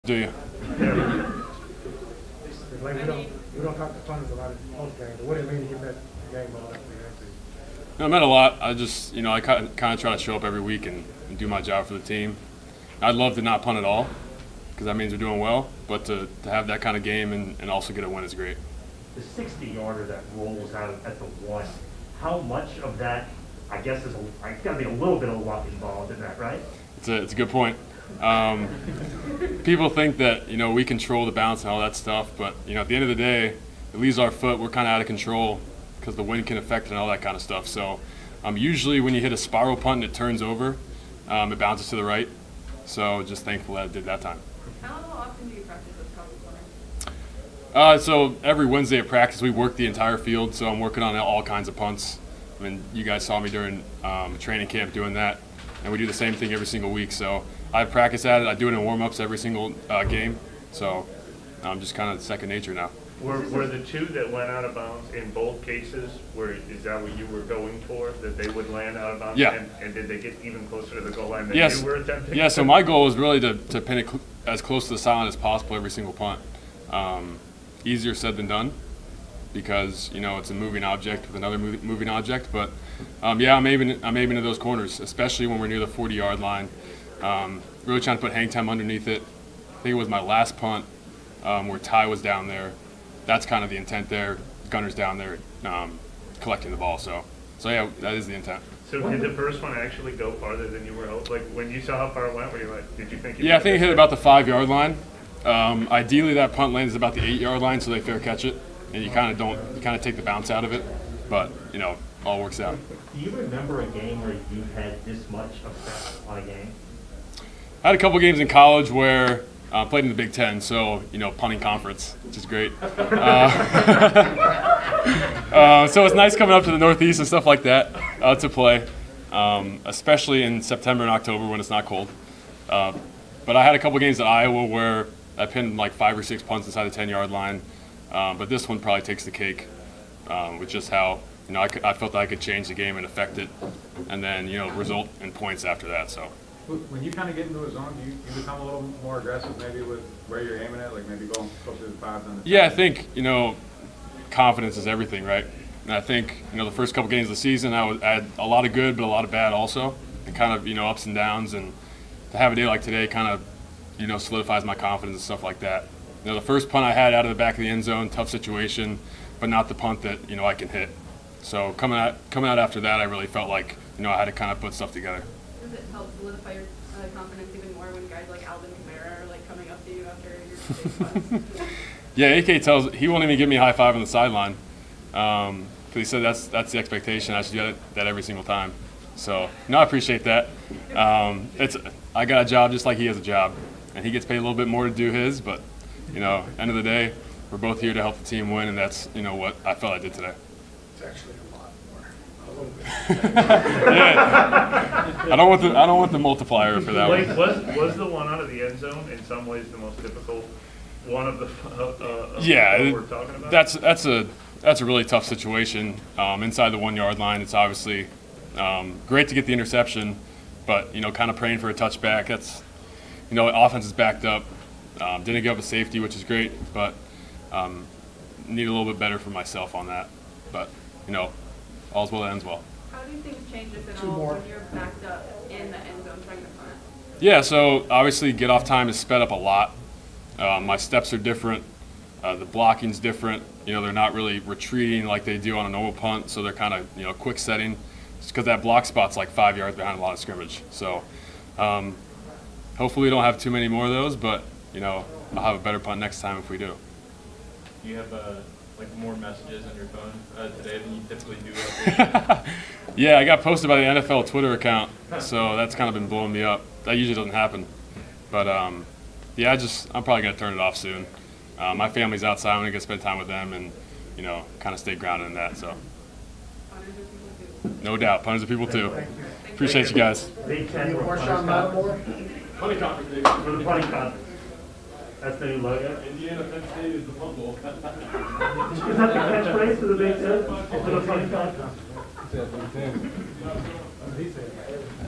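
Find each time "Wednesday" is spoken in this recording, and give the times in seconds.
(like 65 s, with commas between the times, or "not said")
48 s.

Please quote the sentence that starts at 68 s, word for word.
That they would land out of bounds?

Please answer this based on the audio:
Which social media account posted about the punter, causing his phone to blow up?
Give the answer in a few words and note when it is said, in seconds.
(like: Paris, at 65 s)
NFL Twitter account, at 264 s.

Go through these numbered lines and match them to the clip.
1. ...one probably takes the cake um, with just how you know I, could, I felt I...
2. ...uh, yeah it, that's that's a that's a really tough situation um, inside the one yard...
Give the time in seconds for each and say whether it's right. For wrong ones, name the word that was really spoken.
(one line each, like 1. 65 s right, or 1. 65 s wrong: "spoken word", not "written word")
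1. 138 s right
2. 212 s right.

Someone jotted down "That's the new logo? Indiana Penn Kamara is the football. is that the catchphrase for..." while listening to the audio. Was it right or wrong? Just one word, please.
wrong.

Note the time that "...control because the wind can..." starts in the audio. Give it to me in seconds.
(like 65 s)
35 s.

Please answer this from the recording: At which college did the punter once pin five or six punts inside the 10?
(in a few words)
Iowa.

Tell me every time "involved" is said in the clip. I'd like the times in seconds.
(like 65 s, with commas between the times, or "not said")
25 s.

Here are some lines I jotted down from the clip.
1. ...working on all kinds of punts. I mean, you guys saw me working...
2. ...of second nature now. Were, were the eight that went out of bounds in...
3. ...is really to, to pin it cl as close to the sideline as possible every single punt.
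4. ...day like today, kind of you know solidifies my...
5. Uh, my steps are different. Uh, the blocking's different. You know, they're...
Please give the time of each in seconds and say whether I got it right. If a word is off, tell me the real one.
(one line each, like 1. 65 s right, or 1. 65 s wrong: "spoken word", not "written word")
1. 50 s wrong: "during", not "working"
2. 62 s wrong: "two", not "eight"
3. 73 s right
4. 162 s right
5. 240 s right.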